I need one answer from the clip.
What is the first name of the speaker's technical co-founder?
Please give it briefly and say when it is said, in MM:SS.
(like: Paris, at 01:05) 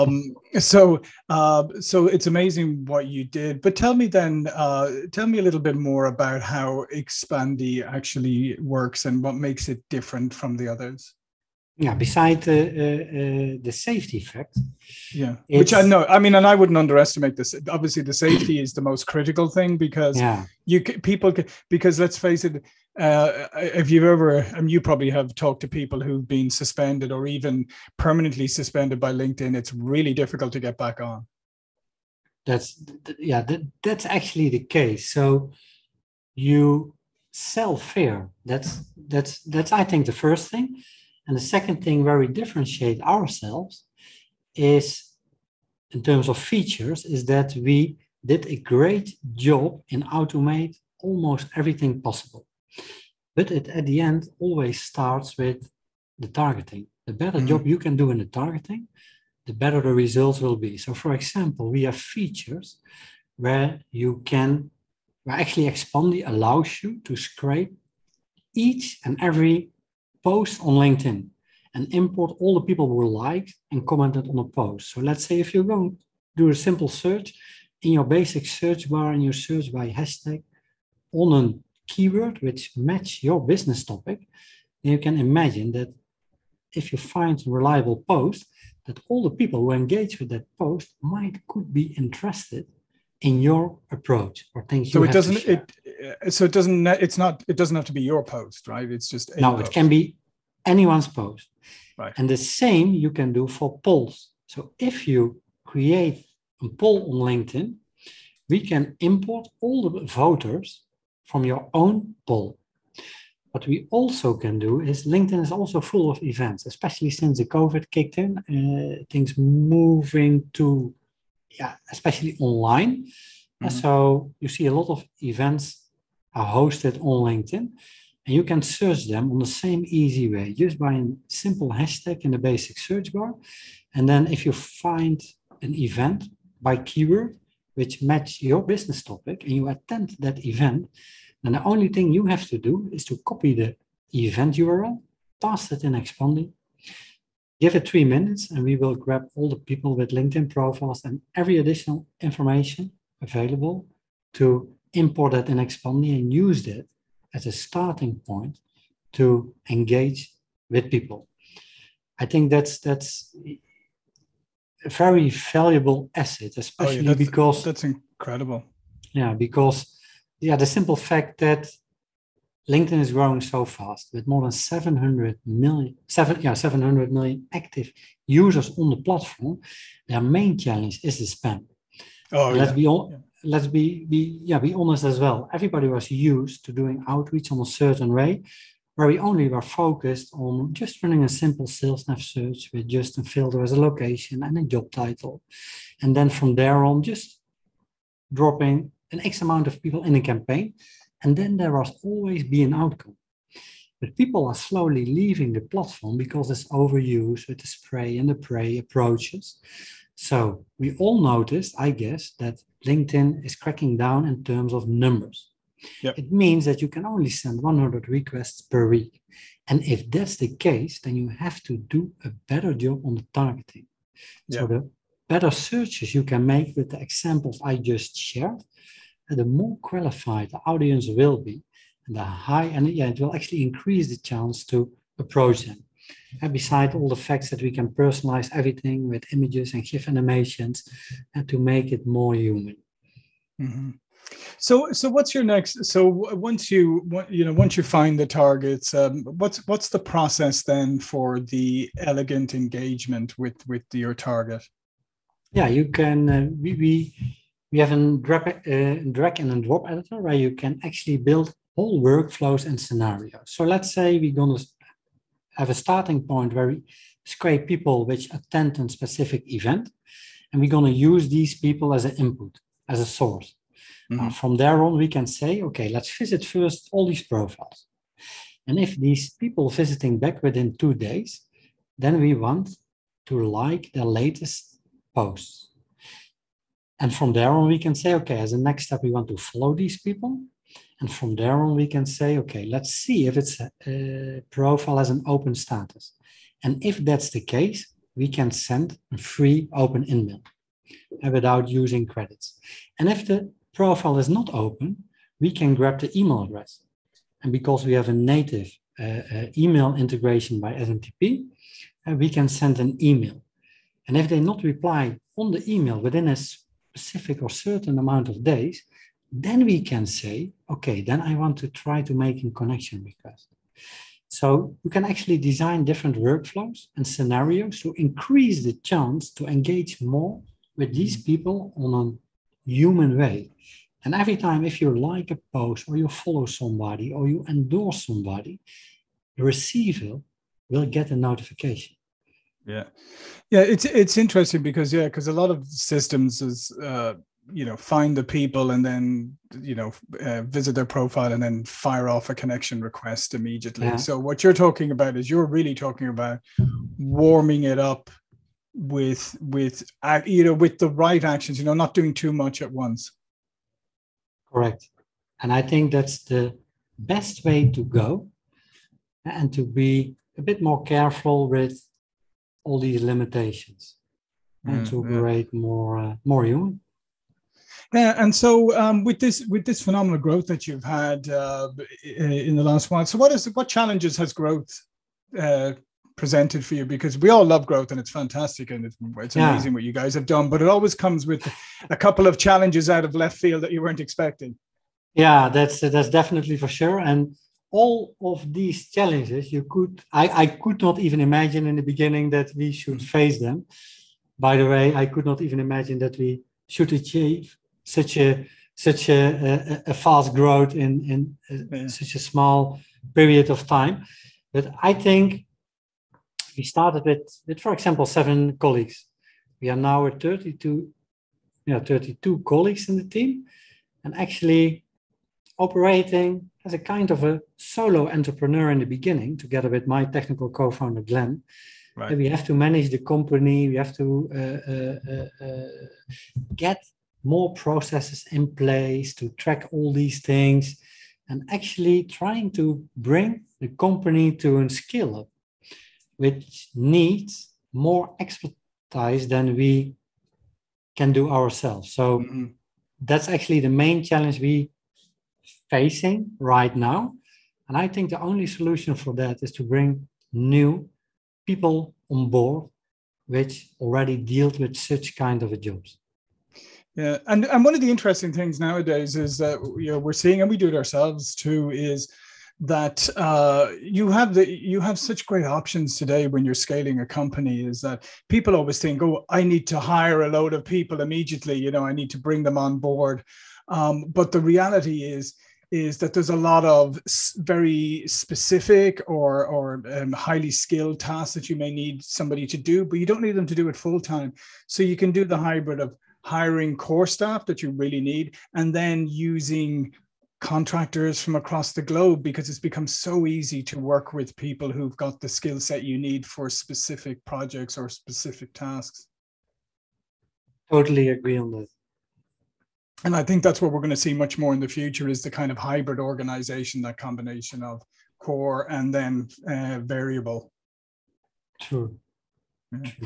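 Glenn, at 07:11.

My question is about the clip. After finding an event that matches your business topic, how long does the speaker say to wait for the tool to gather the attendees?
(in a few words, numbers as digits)
3 minutes.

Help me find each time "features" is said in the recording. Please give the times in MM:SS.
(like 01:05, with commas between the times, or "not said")
00:46, 01:02.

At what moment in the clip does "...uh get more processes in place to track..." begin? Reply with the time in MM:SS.
07:15.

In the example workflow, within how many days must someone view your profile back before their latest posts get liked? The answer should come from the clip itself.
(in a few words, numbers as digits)
2 days.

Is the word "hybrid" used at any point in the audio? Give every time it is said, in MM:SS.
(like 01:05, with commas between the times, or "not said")
08:15, 08:35.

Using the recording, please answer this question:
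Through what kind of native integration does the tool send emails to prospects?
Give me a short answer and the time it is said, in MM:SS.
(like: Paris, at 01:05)
SMTP, at 05:10.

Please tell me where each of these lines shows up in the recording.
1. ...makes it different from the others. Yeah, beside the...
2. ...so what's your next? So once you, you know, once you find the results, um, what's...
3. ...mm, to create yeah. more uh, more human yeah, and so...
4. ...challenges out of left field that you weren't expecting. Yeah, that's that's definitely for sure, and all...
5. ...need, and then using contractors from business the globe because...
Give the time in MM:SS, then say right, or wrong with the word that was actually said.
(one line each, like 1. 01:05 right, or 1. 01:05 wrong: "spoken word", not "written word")
1. 00:09 right
2. 04:04 wrong: "targets", not "results"
3. 06:14 right
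4. 06:32 right
5. 08:18 wrong: "across", not "business".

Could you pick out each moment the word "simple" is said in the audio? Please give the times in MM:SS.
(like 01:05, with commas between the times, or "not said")
01:16, 02:11, 02:50, 03:11.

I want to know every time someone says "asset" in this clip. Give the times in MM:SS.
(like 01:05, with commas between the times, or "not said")
02:46.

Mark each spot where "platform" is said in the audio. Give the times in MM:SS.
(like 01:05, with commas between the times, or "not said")
02:58, 03:25.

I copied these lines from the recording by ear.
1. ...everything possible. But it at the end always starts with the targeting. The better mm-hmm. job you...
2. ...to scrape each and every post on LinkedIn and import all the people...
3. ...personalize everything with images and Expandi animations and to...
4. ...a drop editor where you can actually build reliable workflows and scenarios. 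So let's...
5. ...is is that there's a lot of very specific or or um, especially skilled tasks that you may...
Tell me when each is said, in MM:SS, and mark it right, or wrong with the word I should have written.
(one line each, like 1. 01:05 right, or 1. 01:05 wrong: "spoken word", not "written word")
1. 00:51 right
2. 01:07 right
3. 03:57 wrong: "GIF", not "Expandi"
4. 04:19 wrong: "whole", not "reliable"
5. 08:05 wrong: "highly", not "especially".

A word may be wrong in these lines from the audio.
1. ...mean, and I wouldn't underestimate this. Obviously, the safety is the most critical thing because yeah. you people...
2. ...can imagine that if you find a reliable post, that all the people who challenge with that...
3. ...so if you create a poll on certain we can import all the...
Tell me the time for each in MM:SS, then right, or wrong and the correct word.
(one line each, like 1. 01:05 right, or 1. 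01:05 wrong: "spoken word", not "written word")
1. 00:16 right
2. 01:25 wrong: "engage", not "challenge"
3. 01:44 wrong: "linkedin", not "certain".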